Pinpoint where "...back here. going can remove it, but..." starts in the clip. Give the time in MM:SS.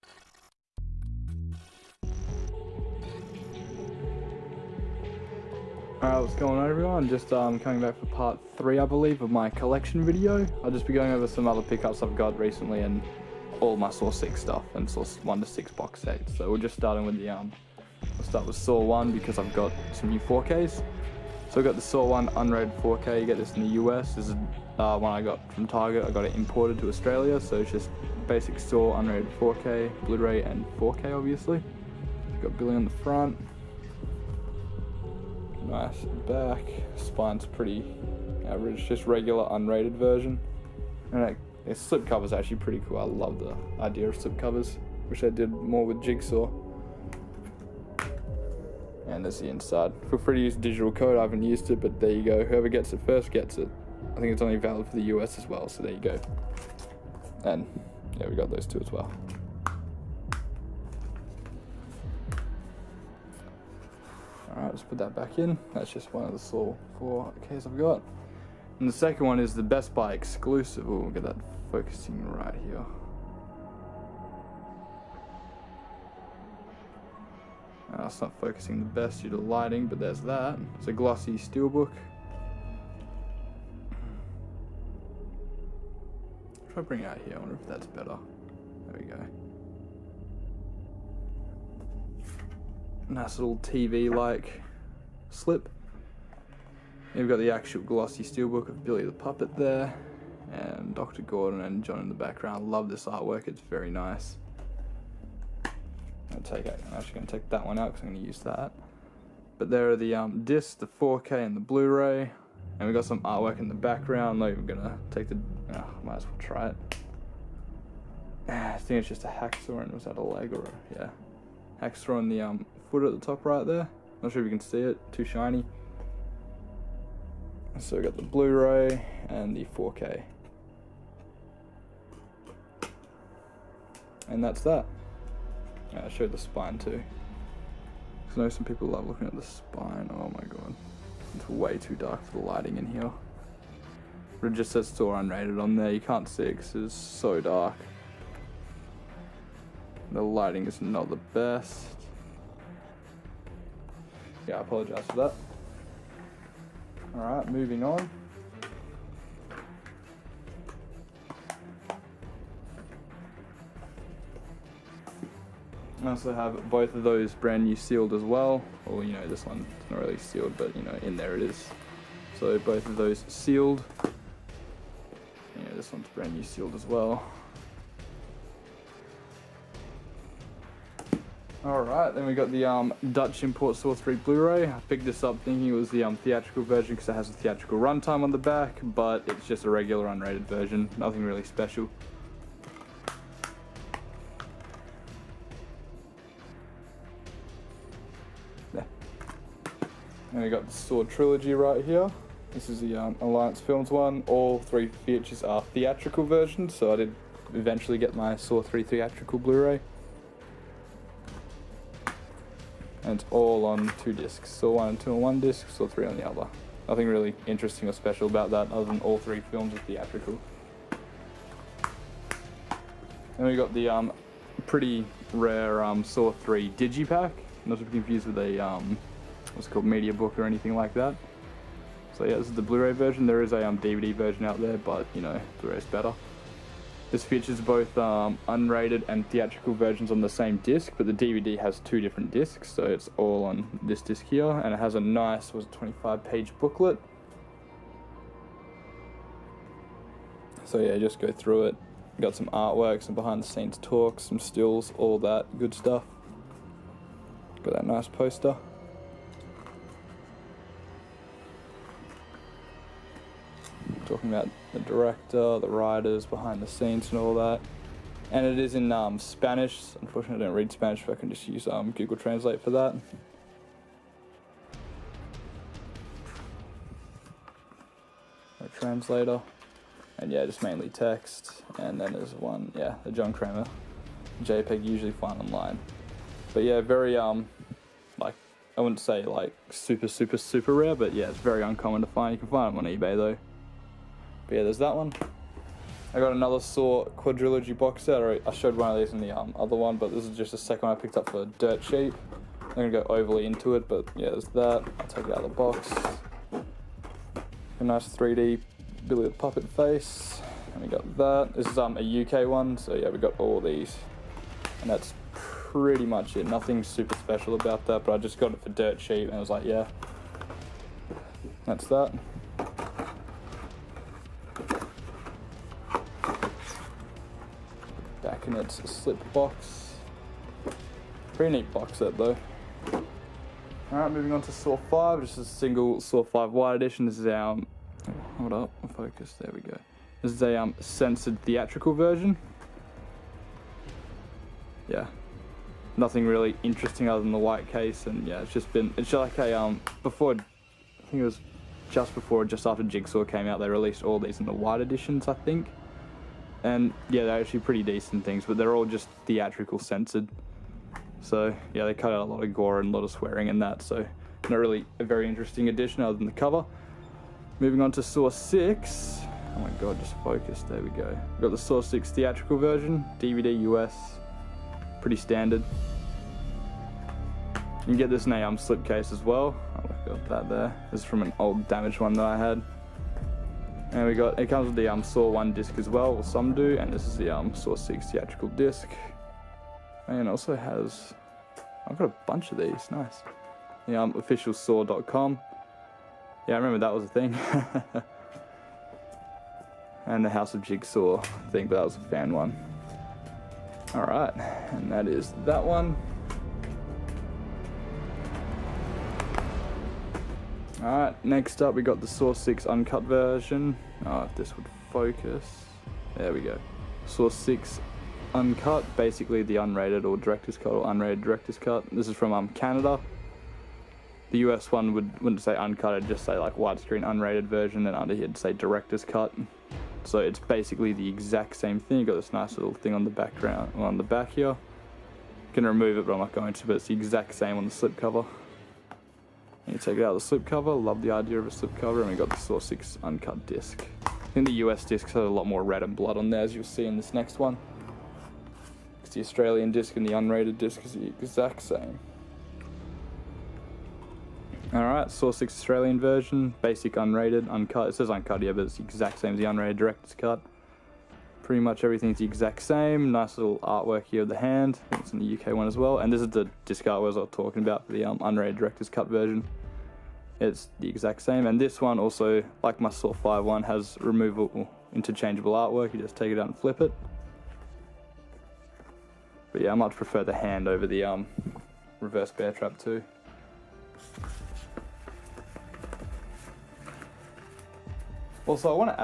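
07:14.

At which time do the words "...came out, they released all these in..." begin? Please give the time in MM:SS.
05:53.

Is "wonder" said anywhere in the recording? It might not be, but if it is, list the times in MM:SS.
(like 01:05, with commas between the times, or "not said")
01:27.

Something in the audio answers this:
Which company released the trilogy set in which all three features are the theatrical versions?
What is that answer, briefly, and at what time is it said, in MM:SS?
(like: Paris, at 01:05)
Alliance Films, at 03:23.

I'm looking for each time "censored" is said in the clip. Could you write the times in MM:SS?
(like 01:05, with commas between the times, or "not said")
05:40, 05:59.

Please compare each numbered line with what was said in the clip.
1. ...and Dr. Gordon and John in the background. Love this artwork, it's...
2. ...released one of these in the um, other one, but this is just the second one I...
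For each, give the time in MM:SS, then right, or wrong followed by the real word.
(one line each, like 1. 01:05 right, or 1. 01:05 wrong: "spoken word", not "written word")
1. 01:40 right
2. 04:58 wrong: "showed", not "released".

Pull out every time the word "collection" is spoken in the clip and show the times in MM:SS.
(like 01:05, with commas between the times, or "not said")
00:09.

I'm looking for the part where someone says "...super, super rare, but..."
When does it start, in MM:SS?
04:50.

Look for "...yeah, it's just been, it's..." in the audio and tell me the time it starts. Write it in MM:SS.
05:48.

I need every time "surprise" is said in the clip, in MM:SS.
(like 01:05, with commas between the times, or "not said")
not said.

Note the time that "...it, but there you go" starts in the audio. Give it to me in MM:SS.
00:51.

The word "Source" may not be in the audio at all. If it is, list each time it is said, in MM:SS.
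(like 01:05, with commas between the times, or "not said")
06:57.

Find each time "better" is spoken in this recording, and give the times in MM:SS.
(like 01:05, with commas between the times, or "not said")
01:27, 03:55.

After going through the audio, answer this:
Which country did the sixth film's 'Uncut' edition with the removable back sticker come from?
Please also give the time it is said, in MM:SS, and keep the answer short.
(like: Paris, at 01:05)
Canada, at 07:02.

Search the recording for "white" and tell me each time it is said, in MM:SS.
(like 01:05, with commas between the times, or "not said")
05:47, 05:54.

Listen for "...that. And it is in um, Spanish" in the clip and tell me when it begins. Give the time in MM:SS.
04:27.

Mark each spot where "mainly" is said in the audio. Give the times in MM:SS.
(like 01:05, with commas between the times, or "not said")
04:40.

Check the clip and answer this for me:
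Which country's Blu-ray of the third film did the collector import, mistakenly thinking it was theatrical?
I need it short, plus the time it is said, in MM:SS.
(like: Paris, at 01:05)
Dutch, at 03:03.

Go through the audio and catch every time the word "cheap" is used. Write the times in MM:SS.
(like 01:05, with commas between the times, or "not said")
05:01, 05:18.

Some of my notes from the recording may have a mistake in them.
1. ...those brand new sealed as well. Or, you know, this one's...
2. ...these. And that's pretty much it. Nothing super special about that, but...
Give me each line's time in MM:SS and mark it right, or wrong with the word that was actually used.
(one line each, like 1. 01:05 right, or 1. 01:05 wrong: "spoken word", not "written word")
1. 02:47 right
2. 05:13 right.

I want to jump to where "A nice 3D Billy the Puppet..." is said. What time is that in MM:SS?
05:07.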